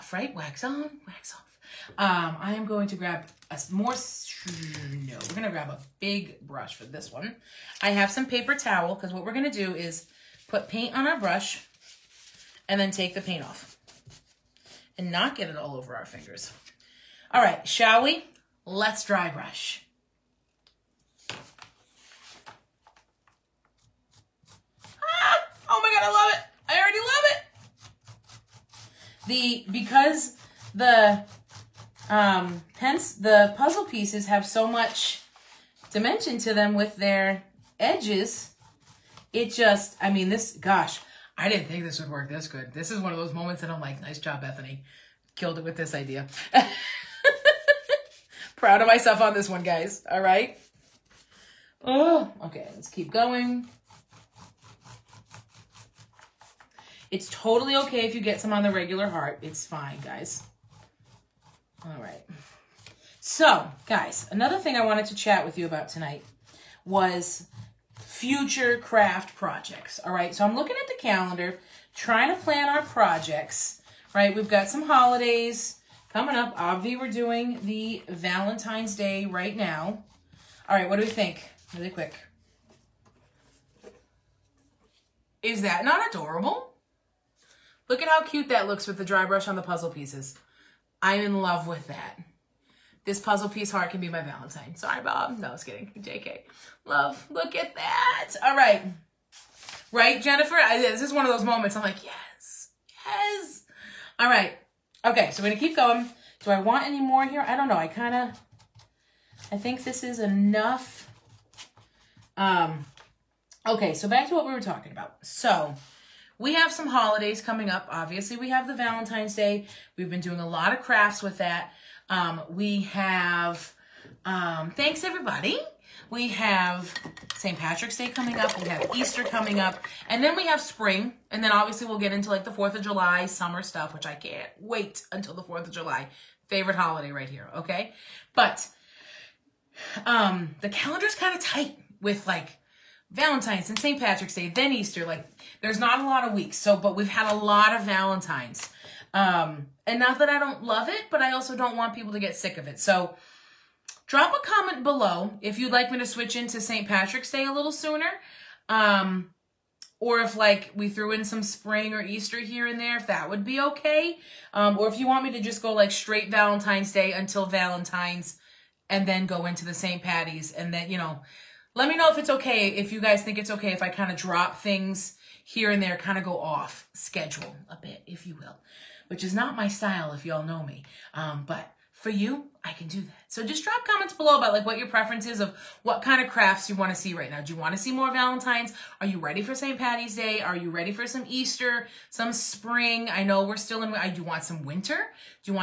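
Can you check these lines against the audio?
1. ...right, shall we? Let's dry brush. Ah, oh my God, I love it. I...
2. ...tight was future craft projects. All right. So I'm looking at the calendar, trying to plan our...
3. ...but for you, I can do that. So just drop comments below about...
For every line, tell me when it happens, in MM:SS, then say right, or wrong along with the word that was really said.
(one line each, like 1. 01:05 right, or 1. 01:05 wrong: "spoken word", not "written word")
1. 00:17 right
2. 01:05 wrong: "tonight", not "tight"
3. 03:01 right.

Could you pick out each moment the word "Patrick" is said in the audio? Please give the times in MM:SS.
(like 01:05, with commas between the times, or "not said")
02:07, 02:23, 02:36.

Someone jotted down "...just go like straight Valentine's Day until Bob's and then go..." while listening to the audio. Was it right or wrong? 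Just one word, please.
wrong.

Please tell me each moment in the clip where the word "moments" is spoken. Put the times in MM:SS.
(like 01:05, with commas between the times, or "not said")
00:43, 01:41.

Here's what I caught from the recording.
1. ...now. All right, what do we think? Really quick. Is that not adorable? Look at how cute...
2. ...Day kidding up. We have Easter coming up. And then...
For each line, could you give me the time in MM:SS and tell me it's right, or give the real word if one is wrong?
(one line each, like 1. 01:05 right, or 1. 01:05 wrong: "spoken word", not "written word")
1. 01:19 right
2. 02:07 wrong: "coming", not "kidding".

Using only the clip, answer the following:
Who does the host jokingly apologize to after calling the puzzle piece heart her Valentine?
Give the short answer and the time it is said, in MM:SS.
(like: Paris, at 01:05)
Bob, at 01:35.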